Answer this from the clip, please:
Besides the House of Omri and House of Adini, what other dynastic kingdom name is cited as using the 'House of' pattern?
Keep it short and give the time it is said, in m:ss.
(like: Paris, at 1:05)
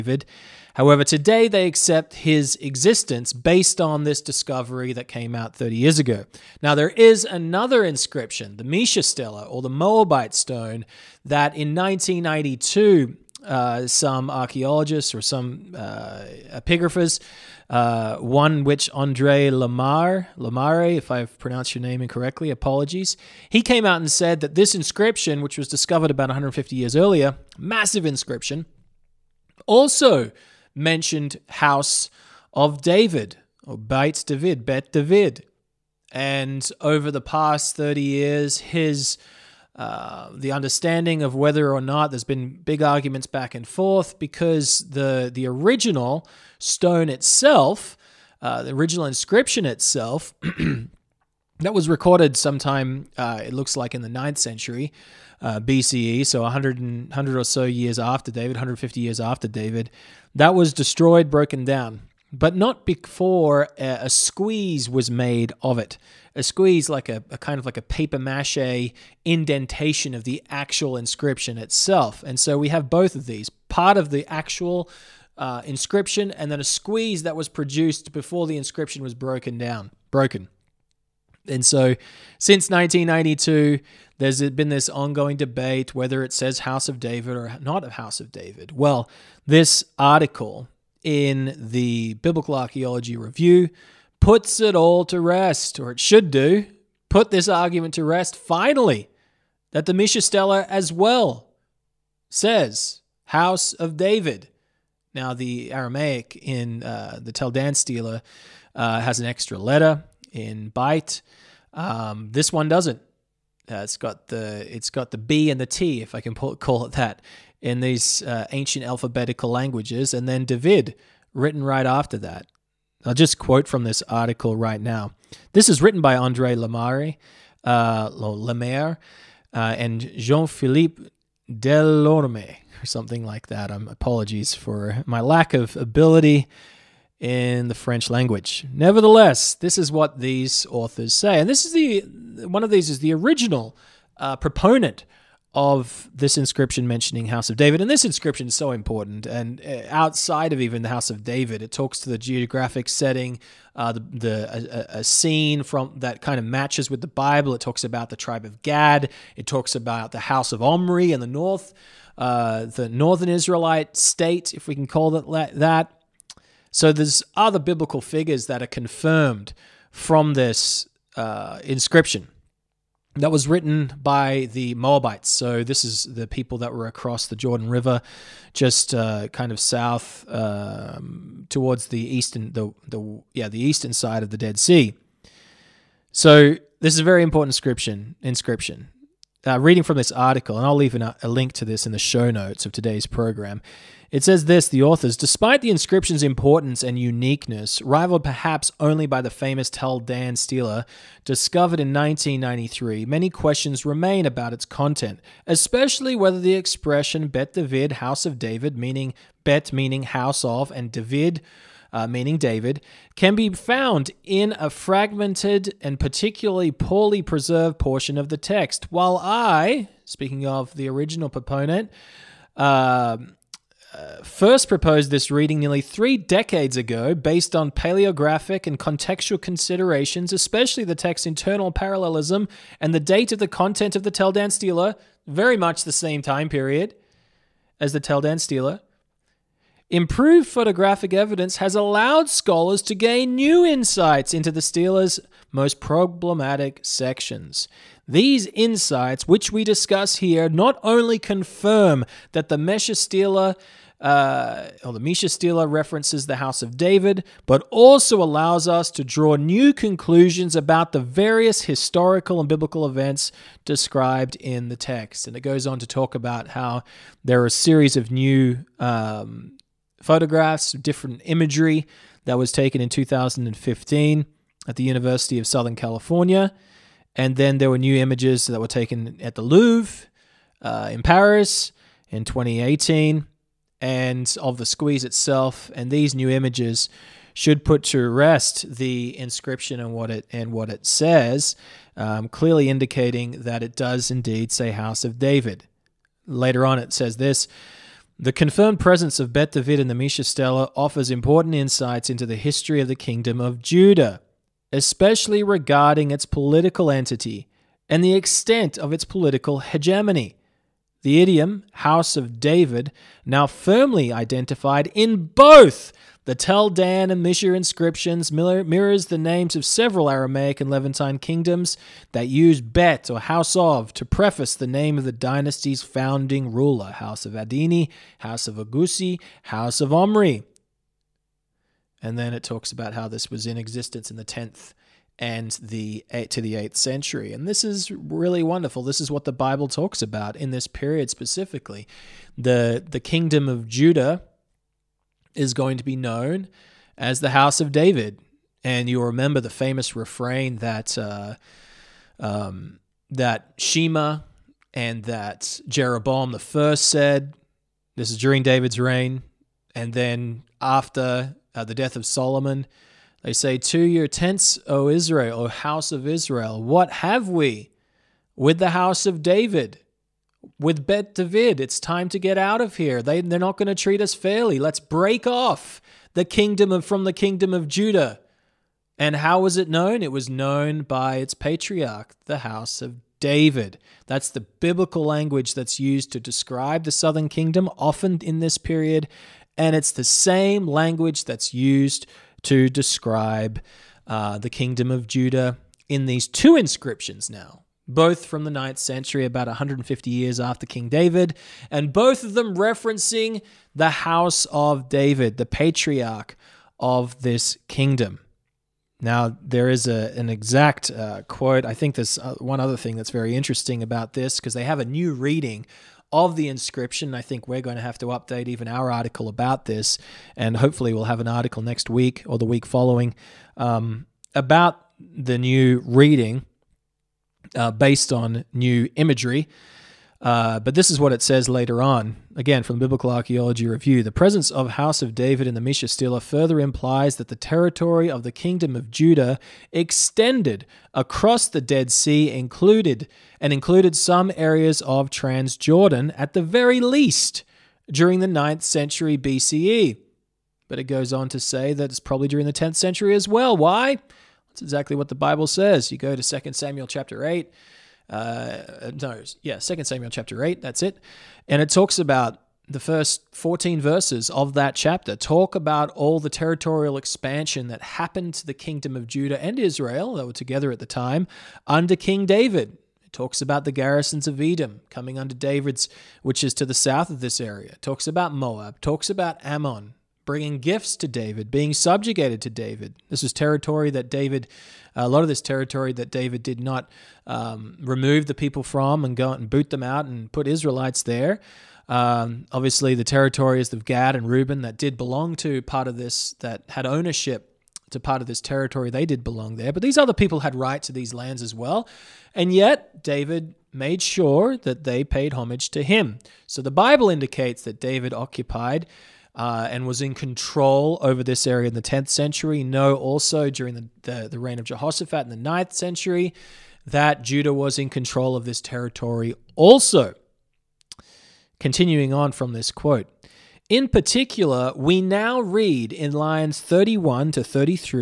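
House of Agusi, at 5:28.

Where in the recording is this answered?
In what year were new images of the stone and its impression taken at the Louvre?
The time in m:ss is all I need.
4:42.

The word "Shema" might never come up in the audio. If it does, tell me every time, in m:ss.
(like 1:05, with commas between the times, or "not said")
5:53.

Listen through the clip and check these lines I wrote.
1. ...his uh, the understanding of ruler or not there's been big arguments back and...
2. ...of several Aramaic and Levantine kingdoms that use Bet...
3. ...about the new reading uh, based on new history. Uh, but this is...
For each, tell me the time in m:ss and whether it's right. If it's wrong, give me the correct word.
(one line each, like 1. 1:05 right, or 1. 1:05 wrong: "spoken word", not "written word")
1. 0:38 wrong: "whether", not "ruler"
2. 5:19 right
3. 7:04 wrong: "imagery", not "history".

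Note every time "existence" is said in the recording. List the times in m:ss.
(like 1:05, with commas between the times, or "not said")
0:02, 5:33.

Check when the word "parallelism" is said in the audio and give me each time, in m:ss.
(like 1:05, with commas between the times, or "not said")
3:51.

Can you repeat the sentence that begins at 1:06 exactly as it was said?
A squeeze, like a, a kind of like a paper mache indentation of the actual inscription itself.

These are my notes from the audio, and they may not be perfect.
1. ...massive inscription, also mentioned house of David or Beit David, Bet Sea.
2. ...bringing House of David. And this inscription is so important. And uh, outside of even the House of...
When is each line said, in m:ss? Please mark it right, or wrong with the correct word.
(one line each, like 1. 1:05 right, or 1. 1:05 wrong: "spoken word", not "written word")
1. 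0:27 wrong: "David", not "Sea"
2. 2:26 wrong: "mentioning", not "bringing".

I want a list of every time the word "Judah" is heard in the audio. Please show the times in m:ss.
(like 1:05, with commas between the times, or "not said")
5:03, 5:43, 6:17, 6:35, 7:18, 7:49, 8:37.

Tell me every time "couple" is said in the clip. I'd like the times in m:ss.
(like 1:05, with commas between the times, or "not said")
not said.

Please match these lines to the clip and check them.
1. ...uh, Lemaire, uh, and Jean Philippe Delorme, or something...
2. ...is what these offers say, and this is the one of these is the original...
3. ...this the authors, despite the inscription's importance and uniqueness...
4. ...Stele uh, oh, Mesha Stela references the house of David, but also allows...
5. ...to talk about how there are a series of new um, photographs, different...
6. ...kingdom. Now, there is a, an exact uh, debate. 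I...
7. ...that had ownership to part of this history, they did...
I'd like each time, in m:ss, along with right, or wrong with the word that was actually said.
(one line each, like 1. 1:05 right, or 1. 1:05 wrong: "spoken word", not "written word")
1. 2:07 right
2. 2:19 wrong: "authors", not "offers"
3. 3:14 right
4. 4:12 right
5. 4:25 right
6. 6:47 wrong: "quote", not "debate"
7. 8:16 wrong: "territory", not "history".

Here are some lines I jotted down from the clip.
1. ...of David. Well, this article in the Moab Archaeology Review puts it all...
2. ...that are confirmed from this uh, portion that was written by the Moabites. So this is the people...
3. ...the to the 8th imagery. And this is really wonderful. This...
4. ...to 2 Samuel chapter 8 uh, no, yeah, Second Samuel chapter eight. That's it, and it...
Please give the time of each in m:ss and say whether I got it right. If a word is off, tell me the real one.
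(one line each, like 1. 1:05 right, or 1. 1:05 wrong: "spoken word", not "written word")
1. 1:28 wrong: "Biblical", not "Moab"
2. 2:48 wrong: "inscription", not "portion"
3. 5:35 wrong: "century", not "imagery"
4. 7:36 right.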